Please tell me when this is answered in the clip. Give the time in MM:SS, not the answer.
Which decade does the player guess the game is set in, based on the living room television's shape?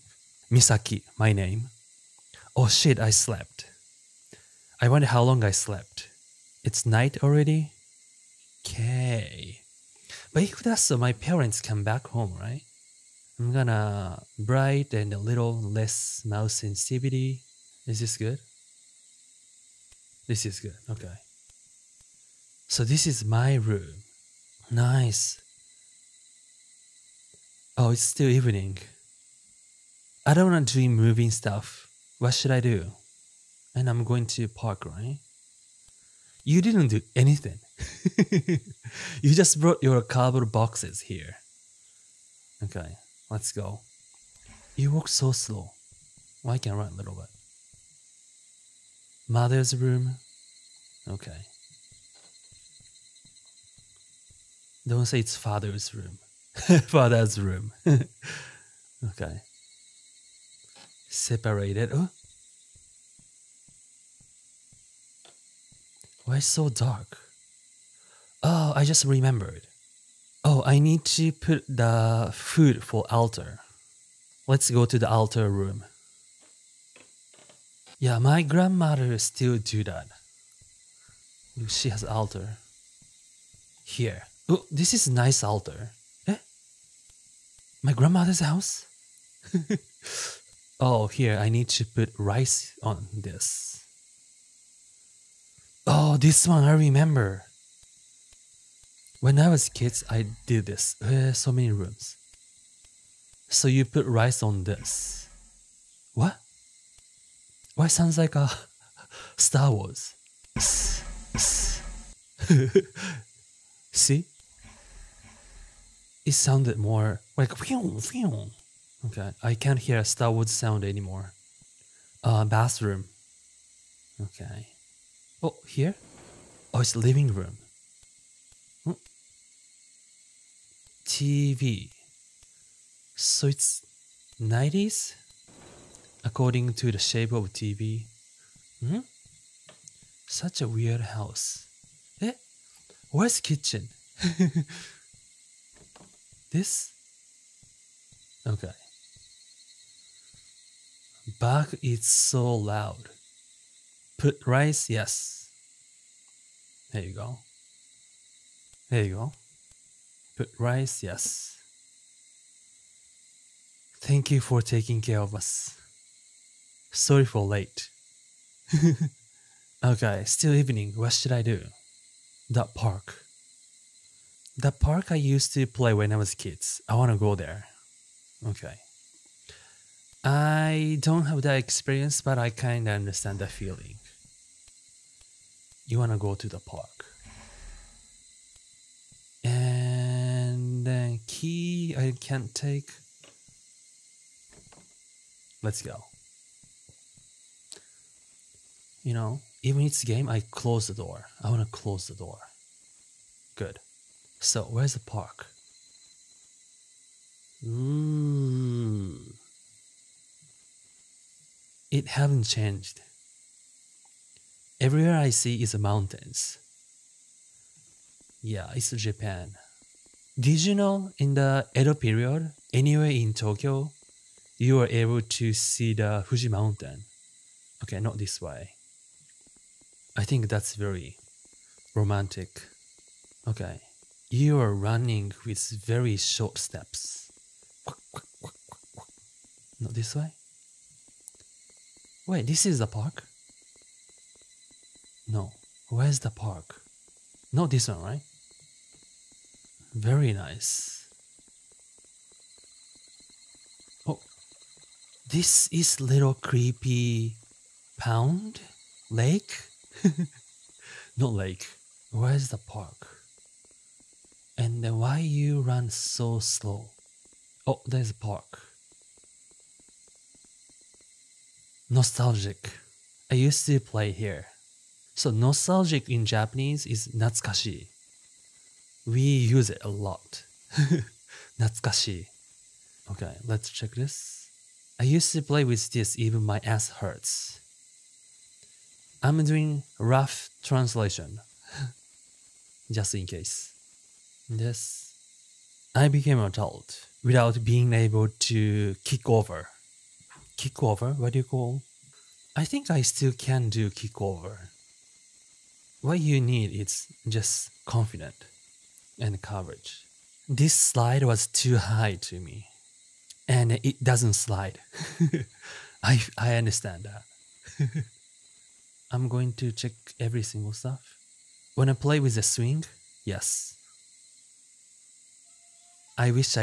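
02:14.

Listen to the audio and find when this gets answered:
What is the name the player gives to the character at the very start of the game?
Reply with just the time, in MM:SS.
00:00.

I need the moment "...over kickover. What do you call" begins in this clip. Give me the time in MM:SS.
04:59.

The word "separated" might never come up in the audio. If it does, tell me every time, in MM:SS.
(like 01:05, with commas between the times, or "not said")
01:01.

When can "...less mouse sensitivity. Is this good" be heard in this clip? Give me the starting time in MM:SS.
00:15.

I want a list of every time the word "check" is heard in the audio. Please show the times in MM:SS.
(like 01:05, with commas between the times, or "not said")
04:43, 05:19.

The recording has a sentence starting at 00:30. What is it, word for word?
I don't want to do moving stuff.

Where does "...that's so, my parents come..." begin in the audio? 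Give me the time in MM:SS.
00:10.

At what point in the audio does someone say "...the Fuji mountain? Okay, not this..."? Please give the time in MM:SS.
03:45.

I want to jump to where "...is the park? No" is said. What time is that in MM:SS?
04:02.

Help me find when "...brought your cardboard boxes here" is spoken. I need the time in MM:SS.
00:39.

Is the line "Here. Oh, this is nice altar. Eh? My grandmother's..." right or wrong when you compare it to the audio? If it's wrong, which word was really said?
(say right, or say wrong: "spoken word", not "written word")
right.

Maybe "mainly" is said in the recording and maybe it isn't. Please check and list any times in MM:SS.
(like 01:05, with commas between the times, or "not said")
not said.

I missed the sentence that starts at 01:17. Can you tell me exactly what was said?
Yeah, my grandmother still do that.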